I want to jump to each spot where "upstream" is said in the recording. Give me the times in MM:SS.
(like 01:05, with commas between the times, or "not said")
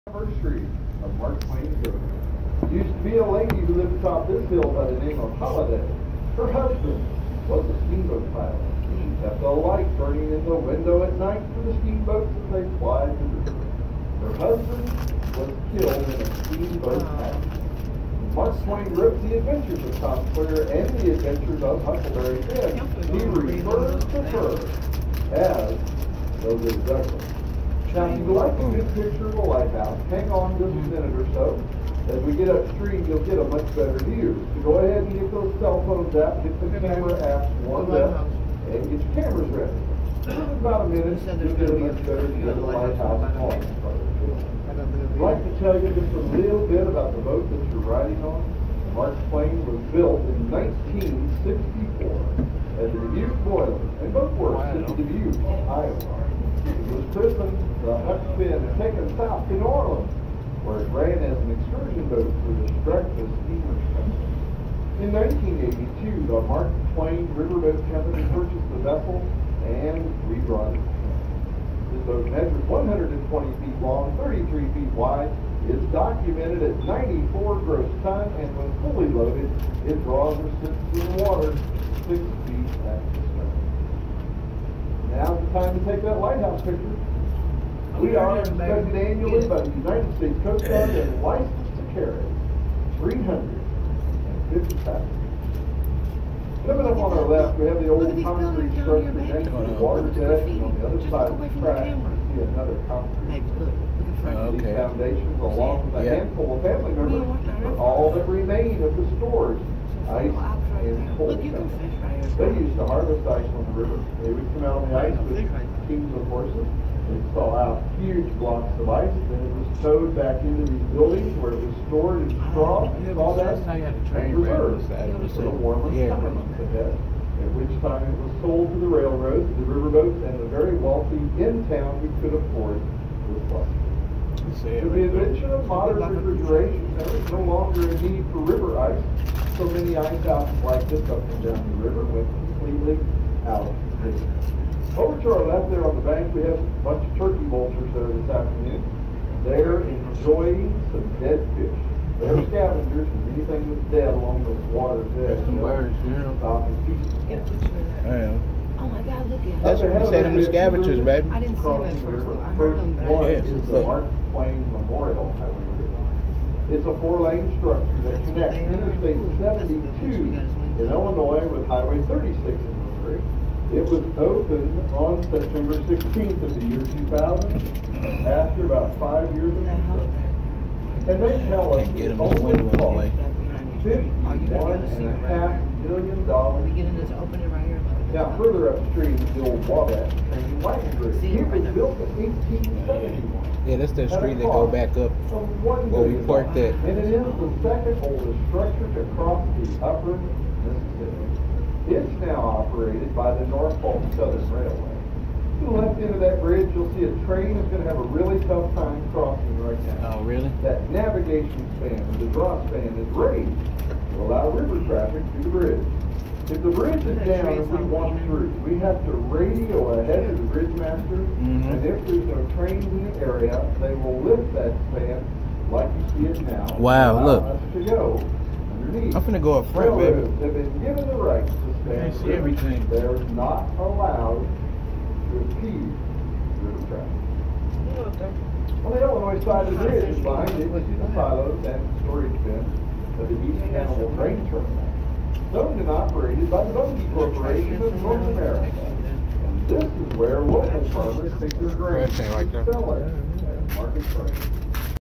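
00:32, 03:08.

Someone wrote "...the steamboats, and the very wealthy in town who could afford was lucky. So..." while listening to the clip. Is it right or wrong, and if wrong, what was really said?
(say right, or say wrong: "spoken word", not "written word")
wrong: "riverboats", not "steamboats".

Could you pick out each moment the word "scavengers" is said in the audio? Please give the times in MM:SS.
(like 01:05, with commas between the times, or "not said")
02:32, 02:40.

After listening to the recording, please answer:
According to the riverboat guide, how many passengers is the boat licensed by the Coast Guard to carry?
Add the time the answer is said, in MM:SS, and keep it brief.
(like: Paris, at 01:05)
350, at 01:32.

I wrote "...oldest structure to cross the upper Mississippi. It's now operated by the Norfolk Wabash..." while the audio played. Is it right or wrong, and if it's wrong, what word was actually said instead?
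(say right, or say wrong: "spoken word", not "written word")
wrong: "Southern", not "Wabash".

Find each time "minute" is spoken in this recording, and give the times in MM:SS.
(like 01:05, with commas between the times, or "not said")
00:30, 00:40.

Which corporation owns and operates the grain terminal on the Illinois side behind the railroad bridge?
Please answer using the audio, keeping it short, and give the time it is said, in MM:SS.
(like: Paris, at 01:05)
Bunge Corporation, at 04:06.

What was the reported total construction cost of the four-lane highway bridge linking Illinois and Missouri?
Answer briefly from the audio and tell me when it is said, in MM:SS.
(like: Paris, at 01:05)
$51.5 million, at 03:03.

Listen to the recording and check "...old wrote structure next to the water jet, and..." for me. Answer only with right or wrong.
wrong.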